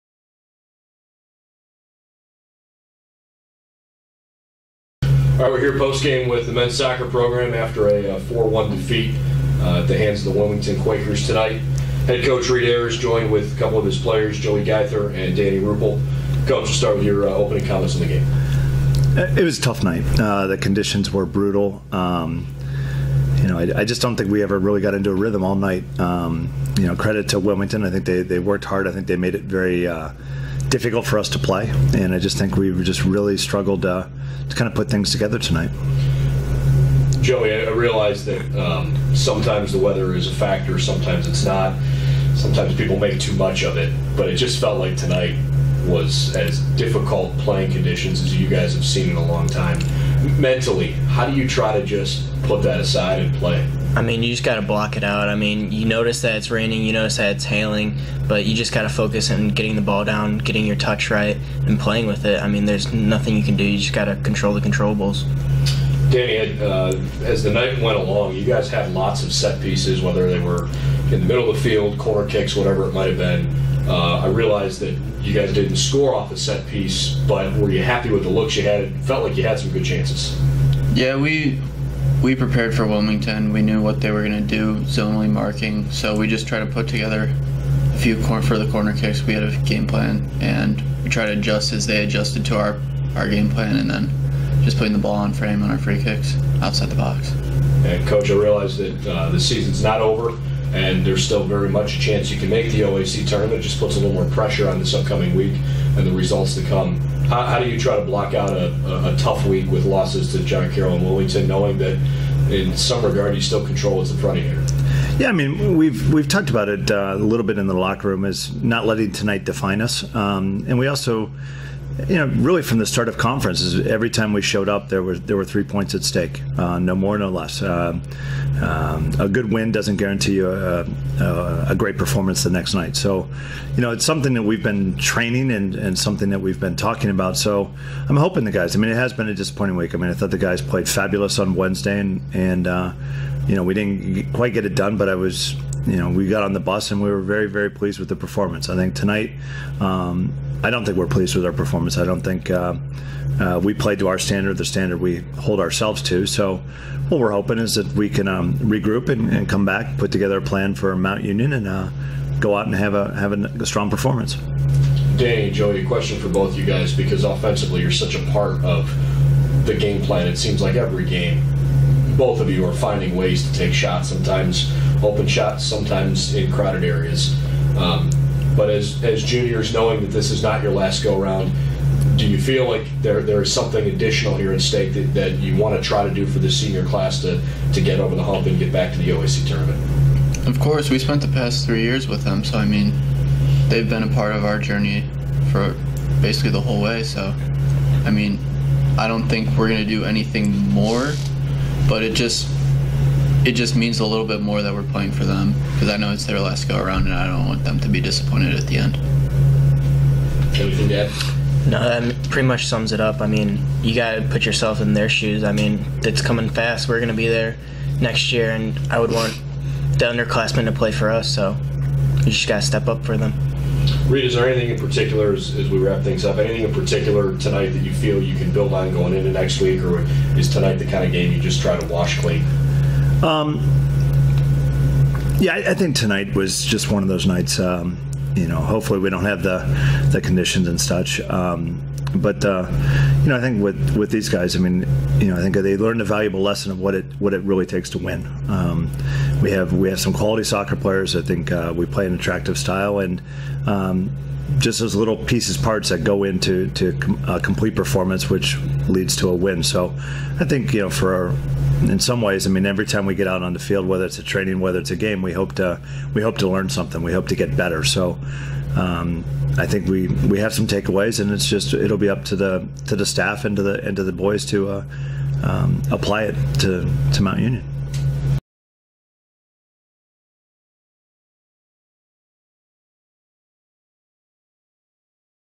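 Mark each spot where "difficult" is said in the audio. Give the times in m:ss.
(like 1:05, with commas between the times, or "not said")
0:30, 0:46.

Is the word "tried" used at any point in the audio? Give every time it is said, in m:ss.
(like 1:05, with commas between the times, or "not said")
1:26, 1:31.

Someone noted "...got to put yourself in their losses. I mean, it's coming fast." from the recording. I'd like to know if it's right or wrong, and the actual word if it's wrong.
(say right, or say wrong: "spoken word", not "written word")
wrong: "shoes", not "losses".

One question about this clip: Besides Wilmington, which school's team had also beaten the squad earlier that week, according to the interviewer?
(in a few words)
John Carroll.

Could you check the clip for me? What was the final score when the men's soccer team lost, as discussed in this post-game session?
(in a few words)
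4-1.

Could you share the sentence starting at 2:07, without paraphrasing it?
Uh, um, a good win doesn't guarantee you a, uh, a, uh, a, great performance the next night.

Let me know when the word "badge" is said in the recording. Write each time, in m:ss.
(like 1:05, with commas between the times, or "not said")
not said.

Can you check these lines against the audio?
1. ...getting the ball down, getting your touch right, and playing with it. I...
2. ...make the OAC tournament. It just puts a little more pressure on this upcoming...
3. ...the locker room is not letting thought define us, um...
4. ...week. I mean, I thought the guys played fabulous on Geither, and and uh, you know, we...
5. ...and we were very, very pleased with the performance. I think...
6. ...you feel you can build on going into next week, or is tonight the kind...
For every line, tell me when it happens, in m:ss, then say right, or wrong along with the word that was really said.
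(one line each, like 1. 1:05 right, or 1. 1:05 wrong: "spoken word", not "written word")
1. 0:59 right
2. 1:42 right
3. 1:57 wrong: "tonight", not "thought"
4. 2:19 wrong: "Wednesday", not "Geither"
5. 2:26 right
6. 3:47 right.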